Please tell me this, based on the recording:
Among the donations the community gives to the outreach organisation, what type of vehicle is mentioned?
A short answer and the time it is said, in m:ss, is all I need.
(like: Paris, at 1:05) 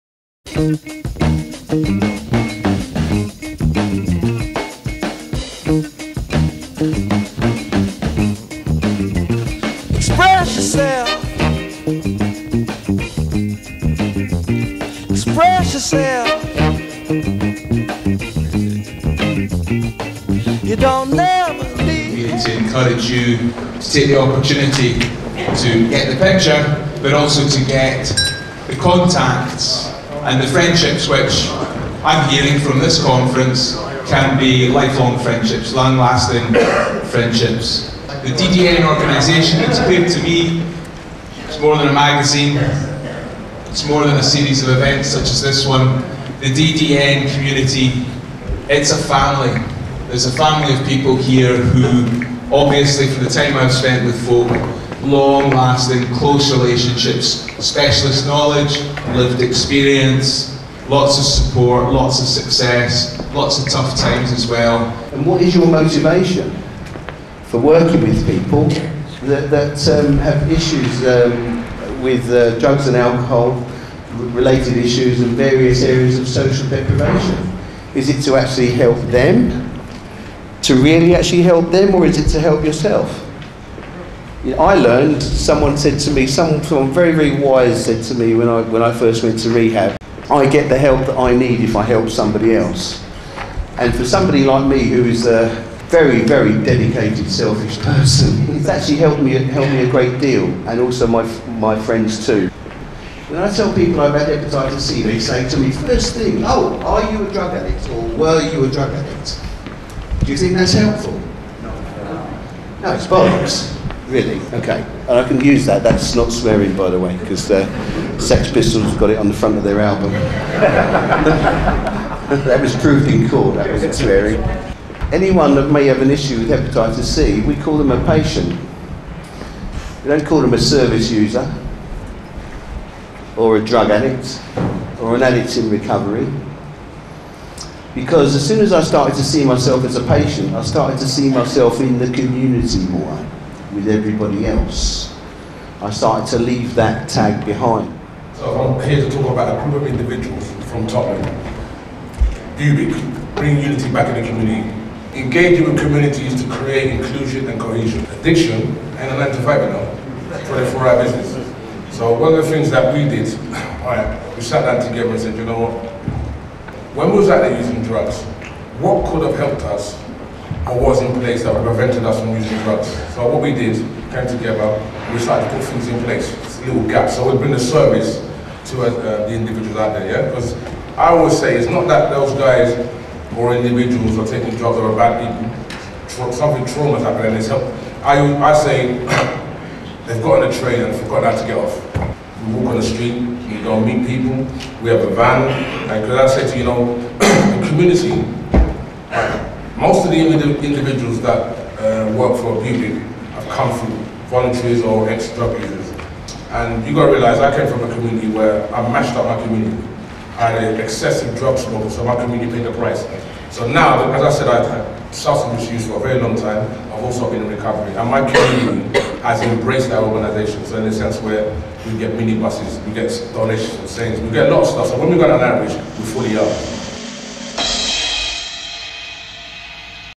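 Minibuses, at 3:42.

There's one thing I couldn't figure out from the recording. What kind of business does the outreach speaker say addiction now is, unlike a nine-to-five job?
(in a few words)
24-hour business.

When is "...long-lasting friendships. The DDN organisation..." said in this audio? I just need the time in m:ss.
0:35.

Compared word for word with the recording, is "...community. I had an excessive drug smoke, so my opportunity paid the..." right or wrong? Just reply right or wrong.
wrong.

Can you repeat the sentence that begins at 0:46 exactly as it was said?
The DDN community, it's a family.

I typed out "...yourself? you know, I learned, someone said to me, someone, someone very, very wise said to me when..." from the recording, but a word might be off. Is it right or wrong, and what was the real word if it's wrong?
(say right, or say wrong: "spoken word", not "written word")
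right.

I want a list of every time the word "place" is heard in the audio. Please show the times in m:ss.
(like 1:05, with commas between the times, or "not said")
2:51, 2:56.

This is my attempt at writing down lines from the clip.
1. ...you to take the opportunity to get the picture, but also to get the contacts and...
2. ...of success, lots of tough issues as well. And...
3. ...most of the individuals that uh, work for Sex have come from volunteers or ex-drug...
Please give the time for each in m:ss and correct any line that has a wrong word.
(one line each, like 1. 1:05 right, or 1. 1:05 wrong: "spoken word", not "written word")
1. 0:23 right
2. 1:02 wrong: "times", not "issues"
3. 3:19 wrong: "BUBIC", not "Sex".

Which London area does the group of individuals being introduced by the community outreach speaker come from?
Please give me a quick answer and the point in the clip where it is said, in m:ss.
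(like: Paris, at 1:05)
Tottenham, at 2:30.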